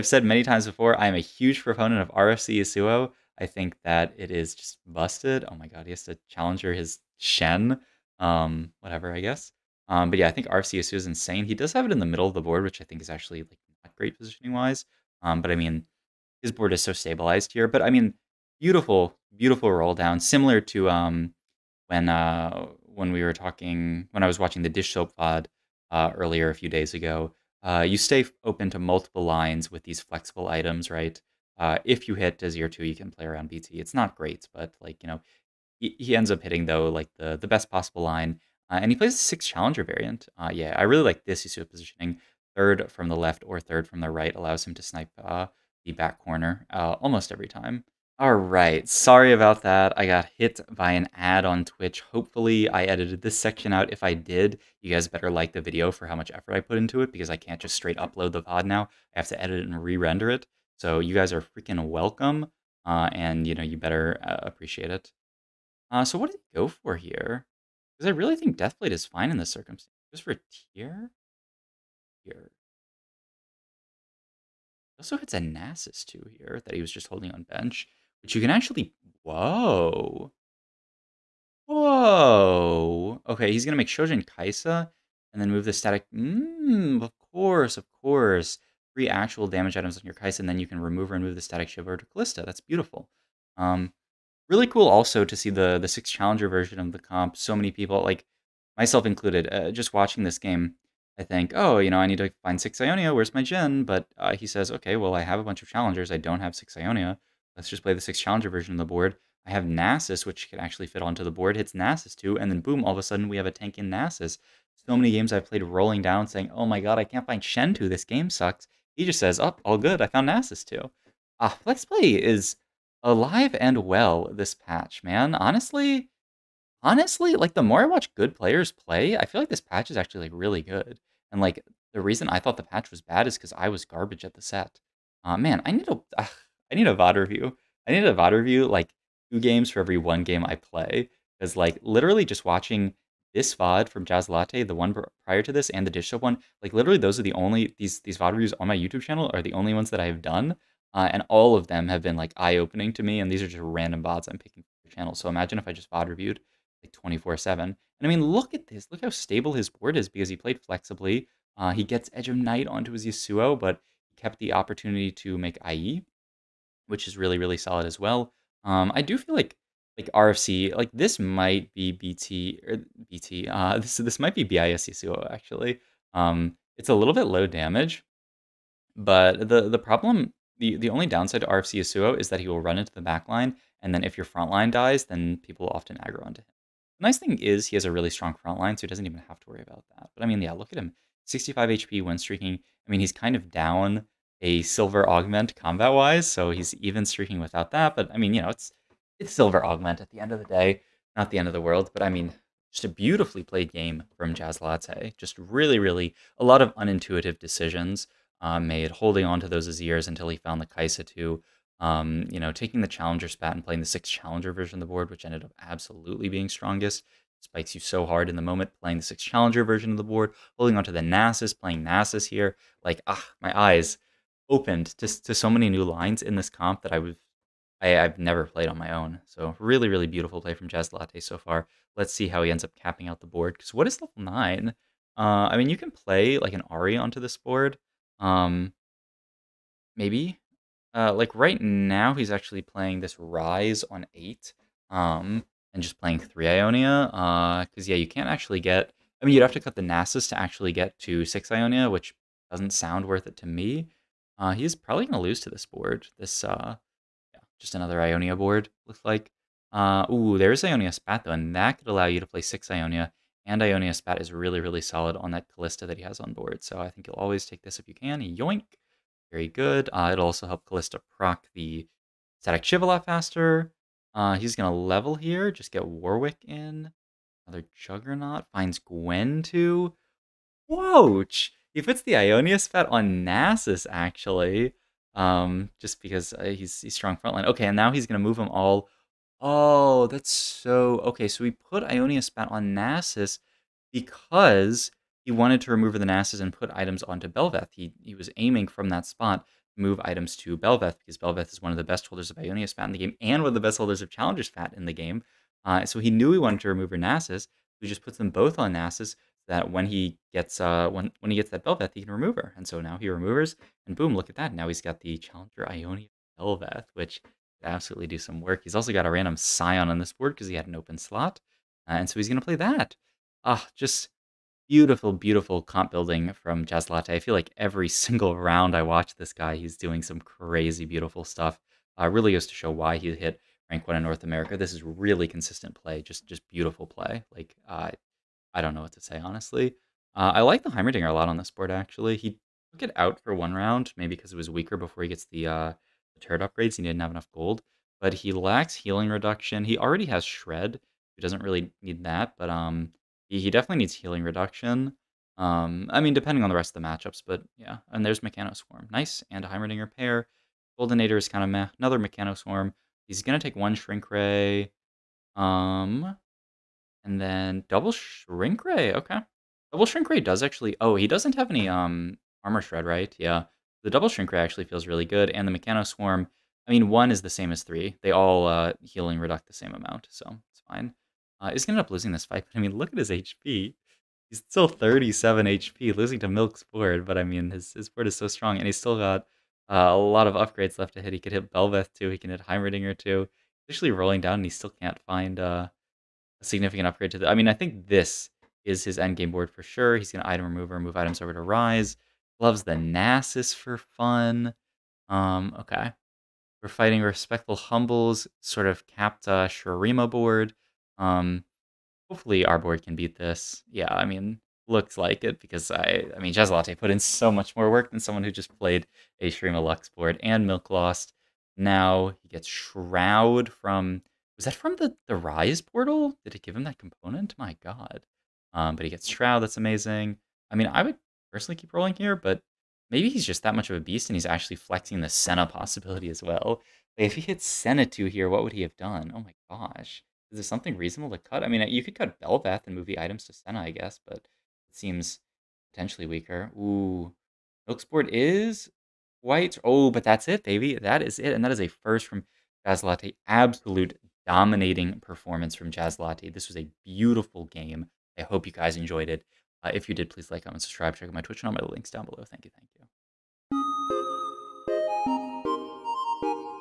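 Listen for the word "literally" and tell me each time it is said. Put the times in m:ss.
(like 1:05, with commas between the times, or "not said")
2:21, 2:26.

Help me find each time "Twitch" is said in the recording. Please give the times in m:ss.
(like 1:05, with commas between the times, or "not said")
0:51, 7:41.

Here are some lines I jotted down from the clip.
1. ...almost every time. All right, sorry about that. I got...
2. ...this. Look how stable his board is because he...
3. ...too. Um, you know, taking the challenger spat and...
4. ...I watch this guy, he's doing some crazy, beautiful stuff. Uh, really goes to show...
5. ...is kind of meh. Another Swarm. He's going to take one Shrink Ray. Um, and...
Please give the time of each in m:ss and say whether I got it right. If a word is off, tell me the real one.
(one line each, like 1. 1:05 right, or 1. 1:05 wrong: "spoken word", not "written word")
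1. 0:46 right
2. 2:38 right
3. 3:31 right
4. 5:28 right
5. 6:01 right.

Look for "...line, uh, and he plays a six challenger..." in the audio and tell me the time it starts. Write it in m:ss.
0:38.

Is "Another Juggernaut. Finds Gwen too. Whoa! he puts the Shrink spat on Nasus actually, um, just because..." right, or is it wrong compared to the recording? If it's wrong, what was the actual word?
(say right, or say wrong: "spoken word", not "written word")
wrong: "Ionia", not "Shrink".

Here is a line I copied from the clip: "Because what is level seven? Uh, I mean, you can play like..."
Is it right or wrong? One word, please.
wrong.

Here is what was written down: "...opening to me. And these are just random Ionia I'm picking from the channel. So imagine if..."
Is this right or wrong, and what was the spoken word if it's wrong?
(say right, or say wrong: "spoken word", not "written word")
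wrong: "VODs", not "Ionia".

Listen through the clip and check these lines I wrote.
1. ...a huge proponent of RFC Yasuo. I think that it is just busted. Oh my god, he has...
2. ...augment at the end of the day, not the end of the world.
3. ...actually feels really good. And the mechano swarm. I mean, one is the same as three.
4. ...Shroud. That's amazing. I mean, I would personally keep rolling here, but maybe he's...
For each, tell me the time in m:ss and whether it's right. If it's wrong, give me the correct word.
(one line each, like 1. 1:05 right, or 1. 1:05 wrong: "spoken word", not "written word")
1. 0:01 right
2. 3:19 right
3. 6:14 right
4. 7:09 right.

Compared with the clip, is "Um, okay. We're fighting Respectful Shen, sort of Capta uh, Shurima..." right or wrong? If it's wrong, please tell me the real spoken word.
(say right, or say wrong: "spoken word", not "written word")
wrong: "Humbles", not "Shen".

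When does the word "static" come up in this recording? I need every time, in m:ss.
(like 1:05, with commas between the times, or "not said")
1:25, 1:31, 4:32.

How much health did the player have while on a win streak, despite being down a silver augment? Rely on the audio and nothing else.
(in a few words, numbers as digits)
65 HP.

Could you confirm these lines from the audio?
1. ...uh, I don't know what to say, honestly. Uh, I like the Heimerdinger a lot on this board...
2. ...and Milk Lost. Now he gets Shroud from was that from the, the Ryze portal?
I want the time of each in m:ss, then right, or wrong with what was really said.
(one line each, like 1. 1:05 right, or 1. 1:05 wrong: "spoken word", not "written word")
1. 5:37 right
2. 7:00 right.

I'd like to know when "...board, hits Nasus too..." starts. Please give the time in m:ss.
1:51.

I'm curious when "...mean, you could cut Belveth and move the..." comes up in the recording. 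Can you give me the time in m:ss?
7:21.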